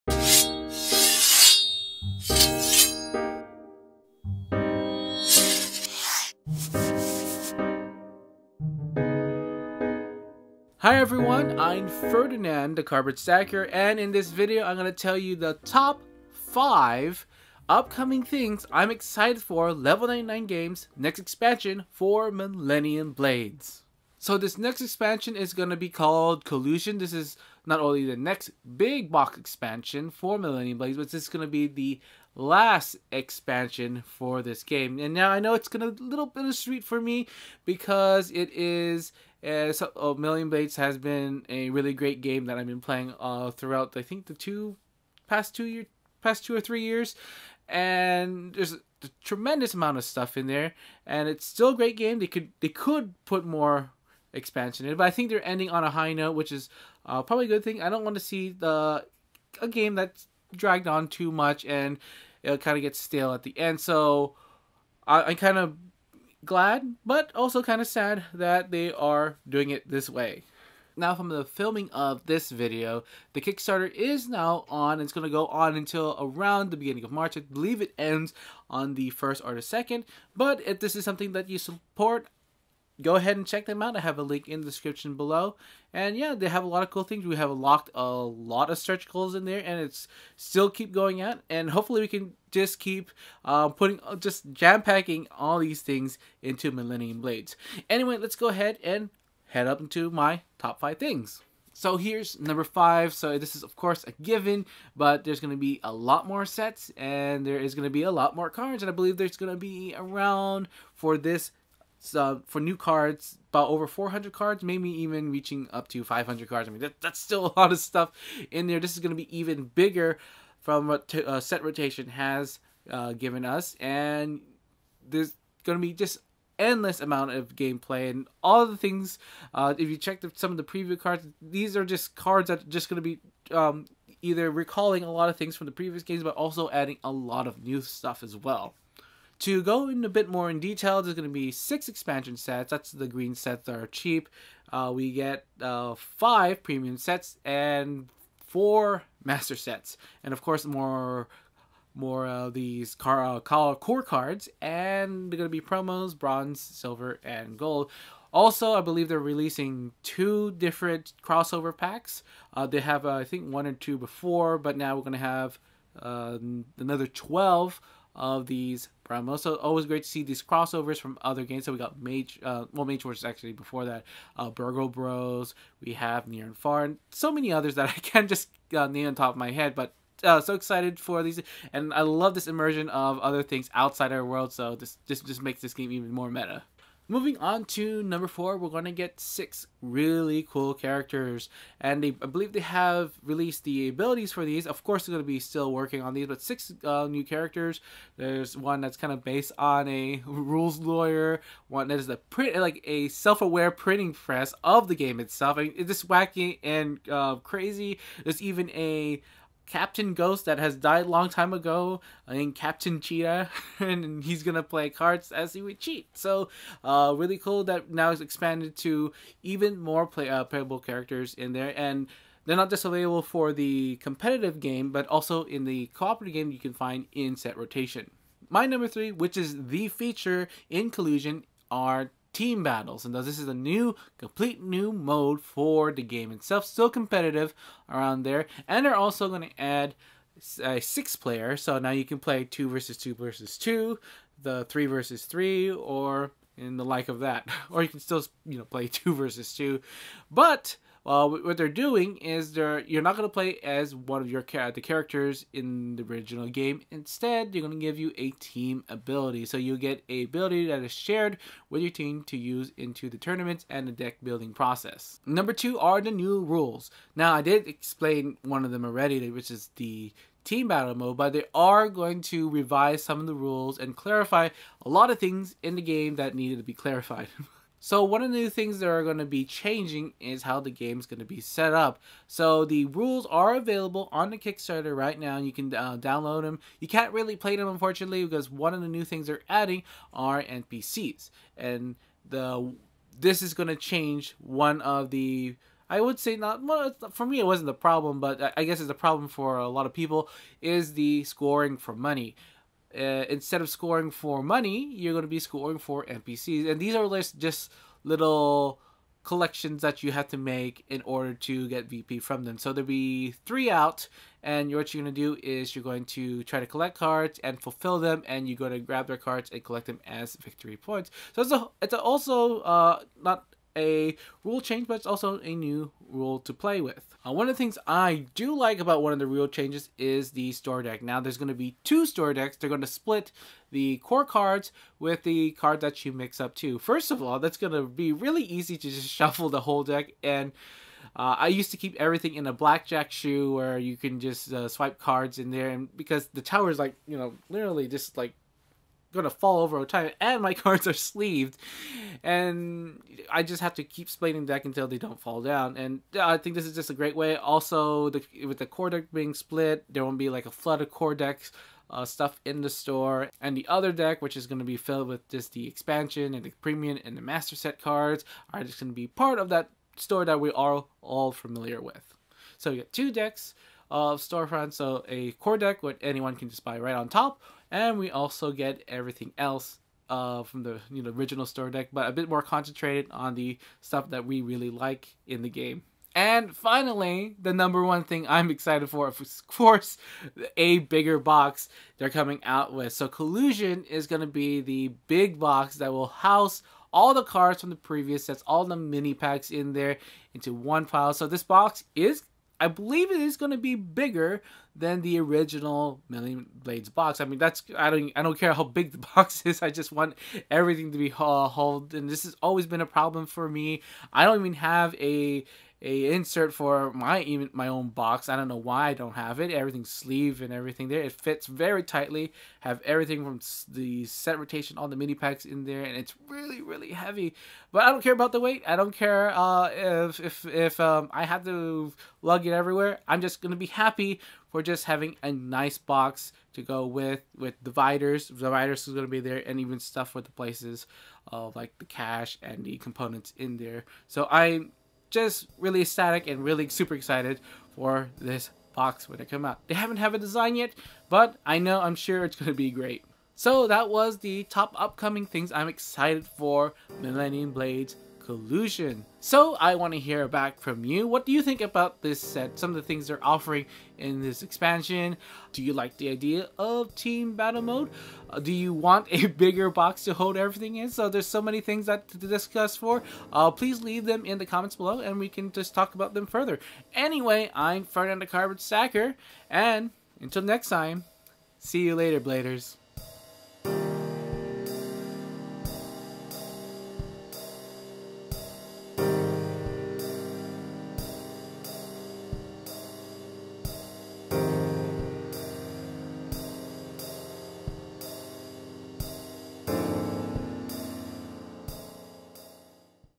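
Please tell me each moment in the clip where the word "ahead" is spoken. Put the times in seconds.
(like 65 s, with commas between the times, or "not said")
83 s, 98 s.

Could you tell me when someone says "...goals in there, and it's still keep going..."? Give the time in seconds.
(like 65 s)
89 s.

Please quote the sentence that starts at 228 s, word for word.
My number three, which is the feature in Collusion, are team battles.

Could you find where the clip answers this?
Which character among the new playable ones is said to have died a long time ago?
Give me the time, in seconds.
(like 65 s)
209 s.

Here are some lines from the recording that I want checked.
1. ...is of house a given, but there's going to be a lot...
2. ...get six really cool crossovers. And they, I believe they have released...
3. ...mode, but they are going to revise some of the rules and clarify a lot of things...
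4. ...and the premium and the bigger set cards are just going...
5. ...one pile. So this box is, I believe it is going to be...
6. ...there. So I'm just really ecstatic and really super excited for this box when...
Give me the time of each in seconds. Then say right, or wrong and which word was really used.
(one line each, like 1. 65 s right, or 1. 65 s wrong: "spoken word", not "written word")
1. 103 s wrong: "course", not "house"
2. 188 s wrong: "characters", not "crossovers"
3. 270 s right
4. 366 s wrong: "master", not "bigger"
5. 400 s right
6. 443 s right.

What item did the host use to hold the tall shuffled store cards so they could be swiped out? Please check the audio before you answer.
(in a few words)
A blackjack shoe.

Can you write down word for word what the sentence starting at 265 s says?
Number two are the new rules.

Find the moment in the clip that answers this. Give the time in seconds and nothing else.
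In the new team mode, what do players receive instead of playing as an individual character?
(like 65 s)
258 s.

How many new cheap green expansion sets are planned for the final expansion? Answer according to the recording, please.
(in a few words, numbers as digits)
6.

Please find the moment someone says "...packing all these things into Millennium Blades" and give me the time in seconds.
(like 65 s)
94 s.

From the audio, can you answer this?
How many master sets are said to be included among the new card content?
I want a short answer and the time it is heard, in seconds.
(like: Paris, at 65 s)
4, at 148 s.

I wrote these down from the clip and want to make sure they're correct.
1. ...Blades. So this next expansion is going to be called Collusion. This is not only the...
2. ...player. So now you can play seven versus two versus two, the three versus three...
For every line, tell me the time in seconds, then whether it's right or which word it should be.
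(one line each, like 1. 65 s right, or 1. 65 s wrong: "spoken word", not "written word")
1. 23 s right
2. 241 s wrong: "two", not "seven".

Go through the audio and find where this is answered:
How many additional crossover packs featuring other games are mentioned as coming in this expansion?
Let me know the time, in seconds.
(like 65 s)
166 s.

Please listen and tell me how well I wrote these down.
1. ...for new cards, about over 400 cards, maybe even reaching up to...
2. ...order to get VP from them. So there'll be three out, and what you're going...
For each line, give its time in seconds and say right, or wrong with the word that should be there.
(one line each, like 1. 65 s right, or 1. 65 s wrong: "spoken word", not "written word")
1. 112 s right
2. 311 s right.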